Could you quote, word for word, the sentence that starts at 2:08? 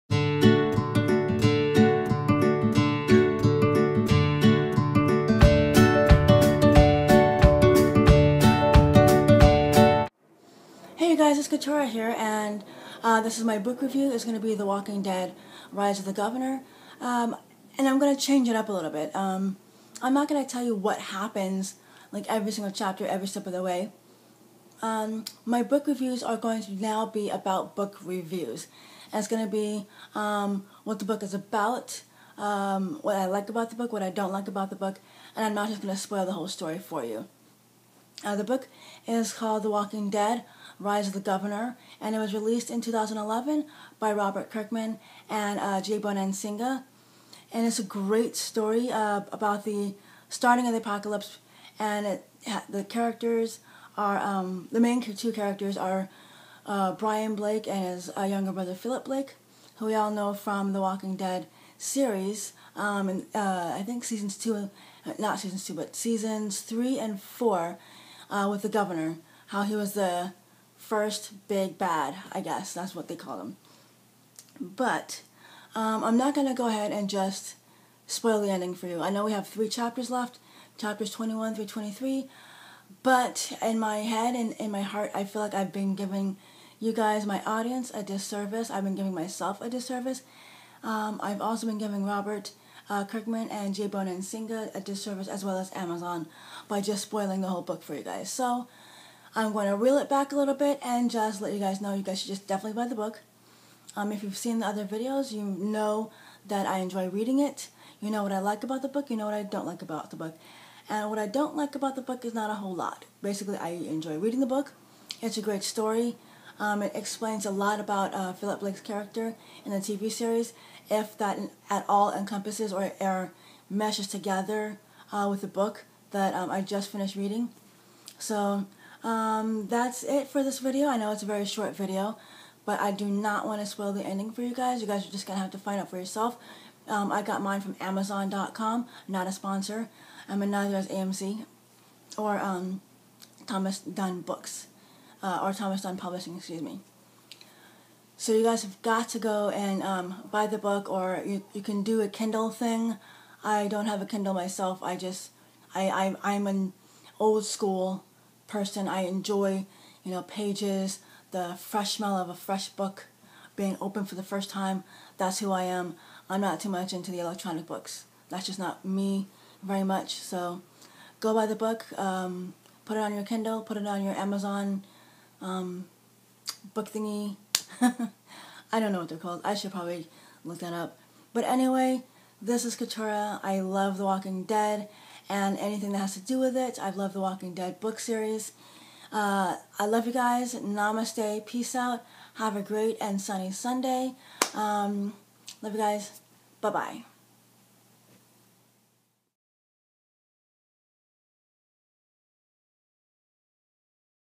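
So um, that's it for this video.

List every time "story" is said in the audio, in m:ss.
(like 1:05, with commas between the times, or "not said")
0:36, 0:48, 1:55.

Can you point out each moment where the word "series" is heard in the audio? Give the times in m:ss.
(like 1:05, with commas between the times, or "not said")
1:01, 2:00, 3:07.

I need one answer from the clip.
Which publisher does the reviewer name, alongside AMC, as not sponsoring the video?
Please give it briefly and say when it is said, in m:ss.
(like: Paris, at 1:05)
Thomas Dunne Books, at 2:23.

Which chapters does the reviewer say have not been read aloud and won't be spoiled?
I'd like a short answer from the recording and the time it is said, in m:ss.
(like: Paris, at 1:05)
21 through 23, at 1:20.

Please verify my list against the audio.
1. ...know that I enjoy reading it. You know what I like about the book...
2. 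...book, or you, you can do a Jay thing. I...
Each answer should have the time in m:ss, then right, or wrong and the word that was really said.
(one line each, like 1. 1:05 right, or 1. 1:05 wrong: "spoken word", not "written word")
1. 1:45 right
2. 2:30 wrong: "Kindle", not "Jay".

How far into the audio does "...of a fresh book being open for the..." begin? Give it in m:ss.
2:42.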